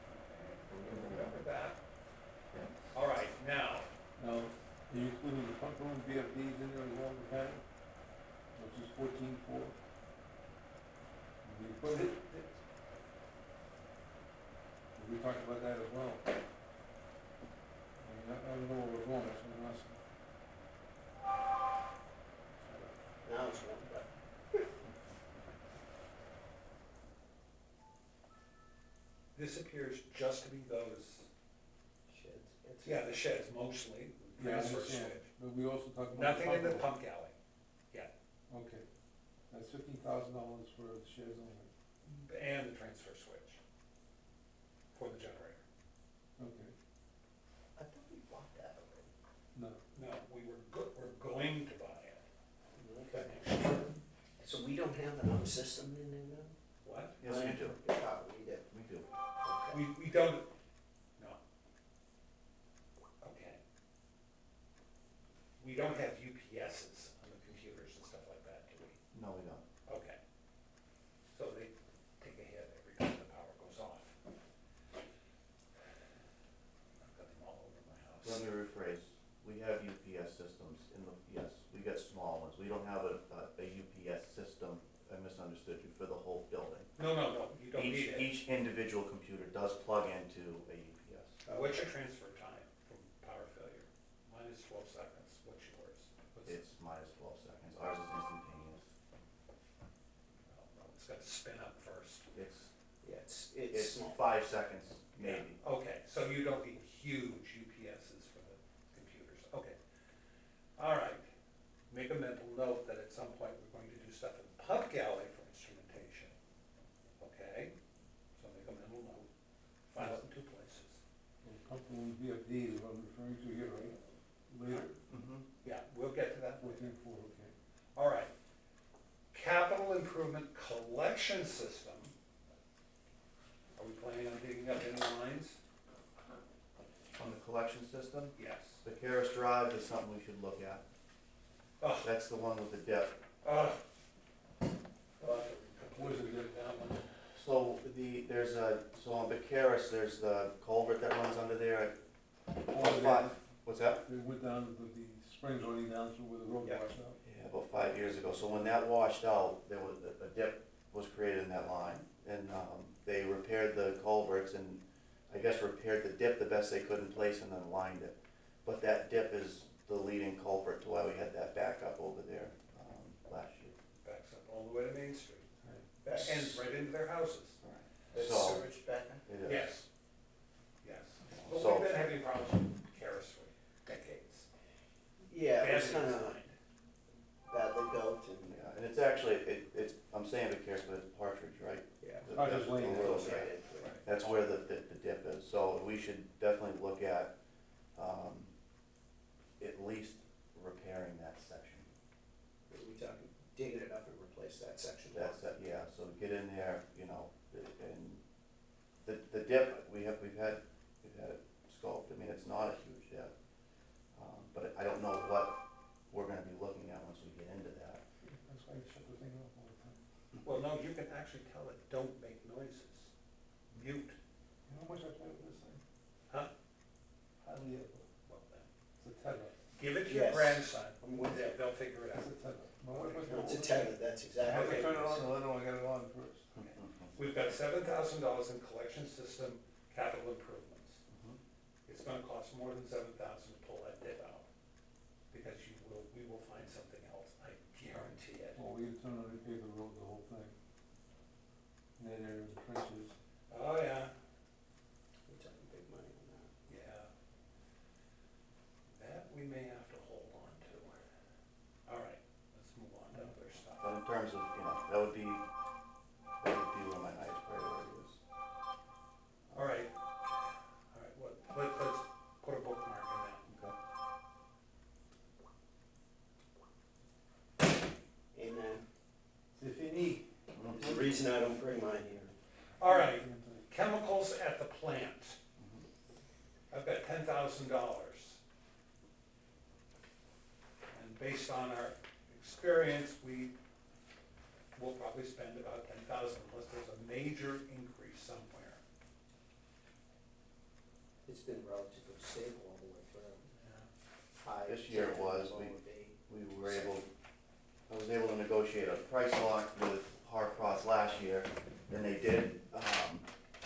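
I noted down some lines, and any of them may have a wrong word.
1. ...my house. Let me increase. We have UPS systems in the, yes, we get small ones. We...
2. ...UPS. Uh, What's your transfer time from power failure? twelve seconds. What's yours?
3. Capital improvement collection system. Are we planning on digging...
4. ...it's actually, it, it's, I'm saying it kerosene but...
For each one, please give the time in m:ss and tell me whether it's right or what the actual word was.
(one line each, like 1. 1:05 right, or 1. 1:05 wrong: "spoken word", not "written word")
1. 1:17 wrong: "rephrase", not "increase"
2. 1:30 right
3. 2:09 right
4. 3:08 right.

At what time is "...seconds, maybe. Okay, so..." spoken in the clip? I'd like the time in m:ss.
1:44.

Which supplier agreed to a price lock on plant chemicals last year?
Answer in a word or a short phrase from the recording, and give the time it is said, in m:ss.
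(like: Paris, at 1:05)
Harcros, at 5:10.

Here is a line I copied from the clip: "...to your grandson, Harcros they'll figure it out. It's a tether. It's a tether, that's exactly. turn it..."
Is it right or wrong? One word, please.
wrong.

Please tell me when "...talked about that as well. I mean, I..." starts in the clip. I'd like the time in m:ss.
0:15.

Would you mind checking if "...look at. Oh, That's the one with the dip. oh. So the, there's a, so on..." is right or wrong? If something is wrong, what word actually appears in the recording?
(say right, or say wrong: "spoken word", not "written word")
right.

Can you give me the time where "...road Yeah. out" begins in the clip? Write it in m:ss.
2:36.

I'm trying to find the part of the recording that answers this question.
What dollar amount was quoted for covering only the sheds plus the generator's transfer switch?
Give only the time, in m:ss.
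0:39.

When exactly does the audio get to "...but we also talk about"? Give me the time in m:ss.
0:35.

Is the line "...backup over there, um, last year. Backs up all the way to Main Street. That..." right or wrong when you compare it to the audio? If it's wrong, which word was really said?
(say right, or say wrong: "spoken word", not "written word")
right.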